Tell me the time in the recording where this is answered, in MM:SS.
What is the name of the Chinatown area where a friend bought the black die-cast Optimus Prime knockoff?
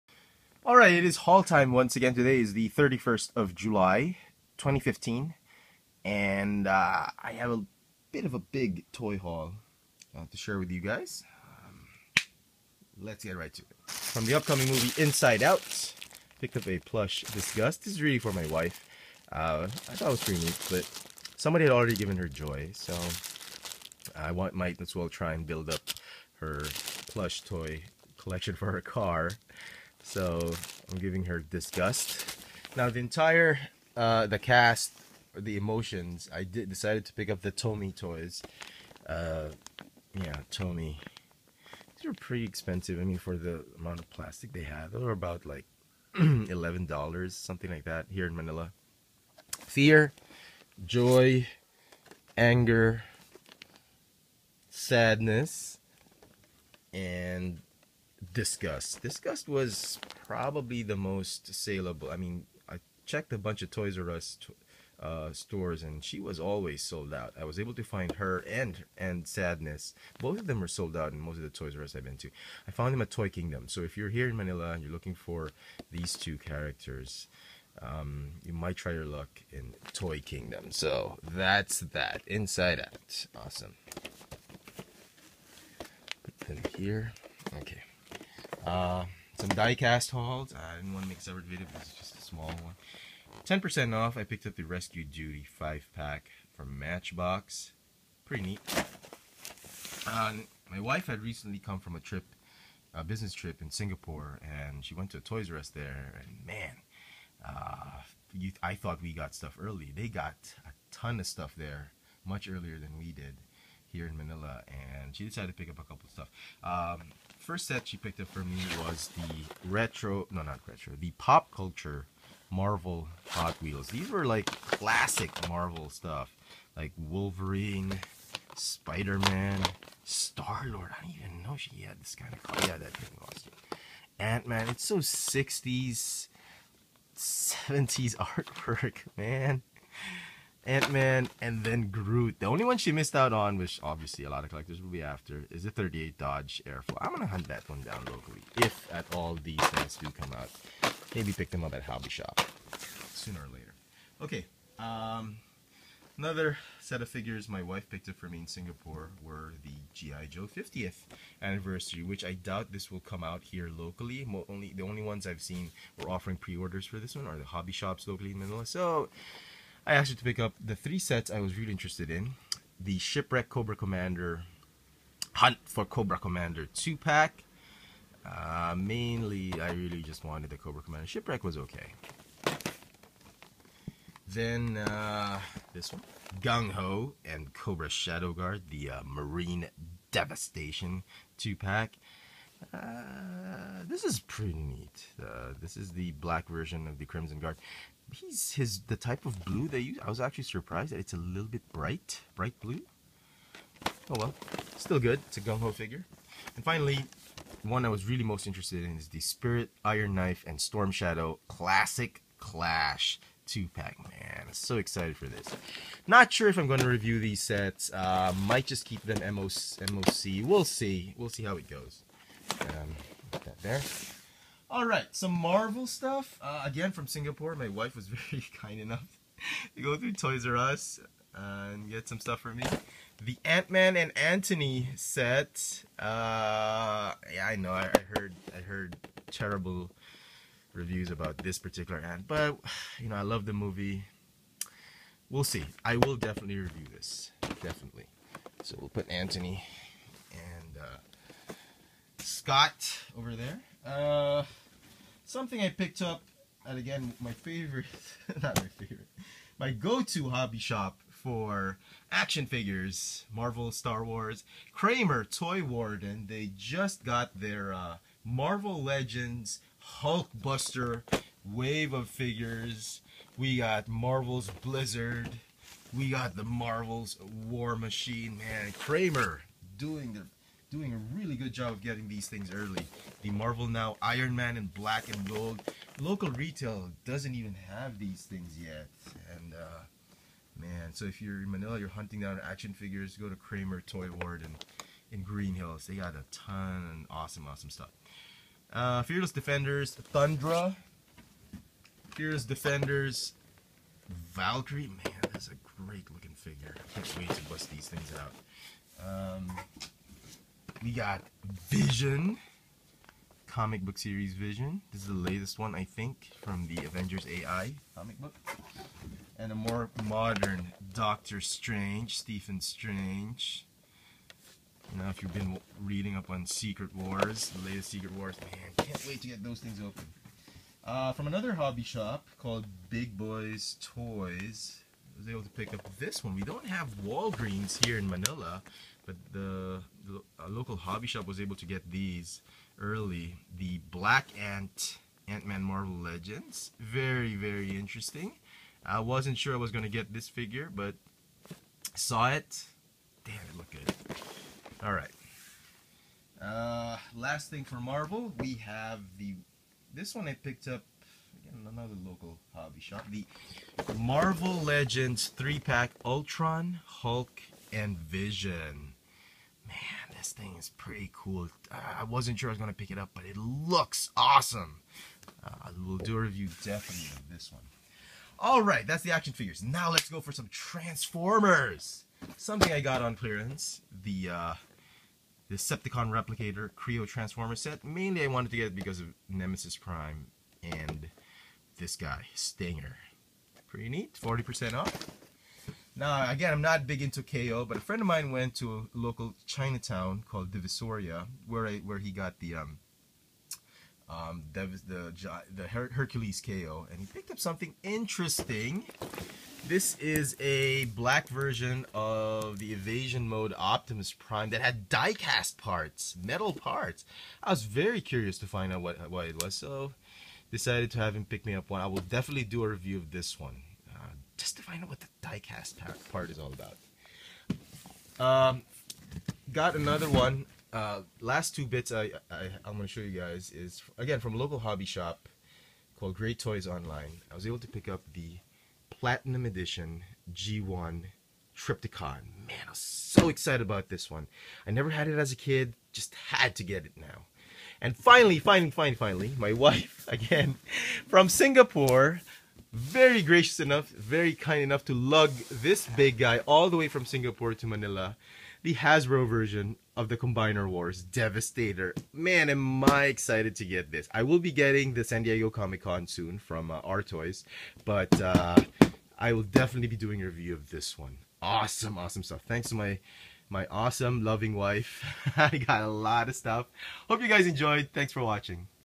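06:40.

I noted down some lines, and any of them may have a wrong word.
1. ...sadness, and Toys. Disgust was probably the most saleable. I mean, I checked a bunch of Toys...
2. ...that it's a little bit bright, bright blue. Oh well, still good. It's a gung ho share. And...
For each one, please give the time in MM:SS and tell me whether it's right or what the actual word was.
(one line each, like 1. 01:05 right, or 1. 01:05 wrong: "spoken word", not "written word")
1. 00:54 wrong: "Disgust", not "Toys"
2. 03:20 wrong: "figure", not "share".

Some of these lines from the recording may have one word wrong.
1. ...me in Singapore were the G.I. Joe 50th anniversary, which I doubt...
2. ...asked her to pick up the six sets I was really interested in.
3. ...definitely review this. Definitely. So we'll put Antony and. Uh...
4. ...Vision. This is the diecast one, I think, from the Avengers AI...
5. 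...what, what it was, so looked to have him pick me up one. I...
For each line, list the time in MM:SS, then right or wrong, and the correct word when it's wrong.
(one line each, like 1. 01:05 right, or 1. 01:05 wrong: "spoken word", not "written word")
1. 02:38 right
2. 02:49 wrong: "three", not "six"
3. 04:06 right
4. 05:14 wrong: "latest", not "diecast"
5. 06:58 wrong: "decided", not "looked".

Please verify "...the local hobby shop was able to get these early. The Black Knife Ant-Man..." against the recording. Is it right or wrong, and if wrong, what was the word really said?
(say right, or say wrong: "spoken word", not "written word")
wrong: "Ant", not "Knife".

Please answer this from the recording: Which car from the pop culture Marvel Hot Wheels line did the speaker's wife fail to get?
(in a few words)
38 Dodge Airflow.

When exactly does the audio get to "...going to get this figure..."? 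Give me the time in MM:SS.
05:49.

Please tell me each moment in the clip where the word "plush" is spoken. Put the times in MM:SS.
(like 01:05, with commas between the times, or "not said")
00:16, 00:27.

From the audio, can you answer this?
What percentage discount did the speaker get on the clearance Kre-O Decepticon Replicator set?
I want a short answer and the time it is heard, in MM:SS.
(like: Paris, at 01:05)
40%, at 06:34.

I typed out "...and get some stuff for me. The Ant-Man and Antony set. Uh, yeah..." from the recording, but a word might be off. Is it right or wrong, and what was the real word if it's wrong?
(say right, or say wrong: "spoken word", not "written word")
right.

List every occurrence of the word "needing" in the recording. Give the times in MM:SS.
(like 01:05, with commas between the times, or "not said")
not said.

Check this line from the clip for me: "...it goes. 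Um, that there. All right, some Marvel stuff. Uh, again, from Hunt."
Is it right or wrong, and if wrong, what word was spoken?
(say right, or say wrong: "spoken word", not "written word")
wrong: "Singapore", not "Hunt".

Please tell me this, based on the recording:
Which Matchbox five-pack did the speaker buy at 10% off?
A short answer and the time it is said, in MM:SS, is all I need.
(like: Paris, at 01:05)
Rescue Duty, at 01:34.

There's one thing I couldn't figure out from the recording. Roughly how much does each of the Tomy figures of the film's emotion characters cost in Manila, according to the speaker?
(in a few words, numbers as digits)
11 dollars.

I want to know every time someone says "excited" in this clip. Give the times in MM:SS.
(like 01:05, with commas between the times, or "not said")
03:34, 07:23, 07:43.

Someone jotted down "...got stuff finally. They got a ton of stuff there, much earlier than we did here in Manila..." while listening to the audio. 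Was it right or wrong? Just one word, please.
wrong.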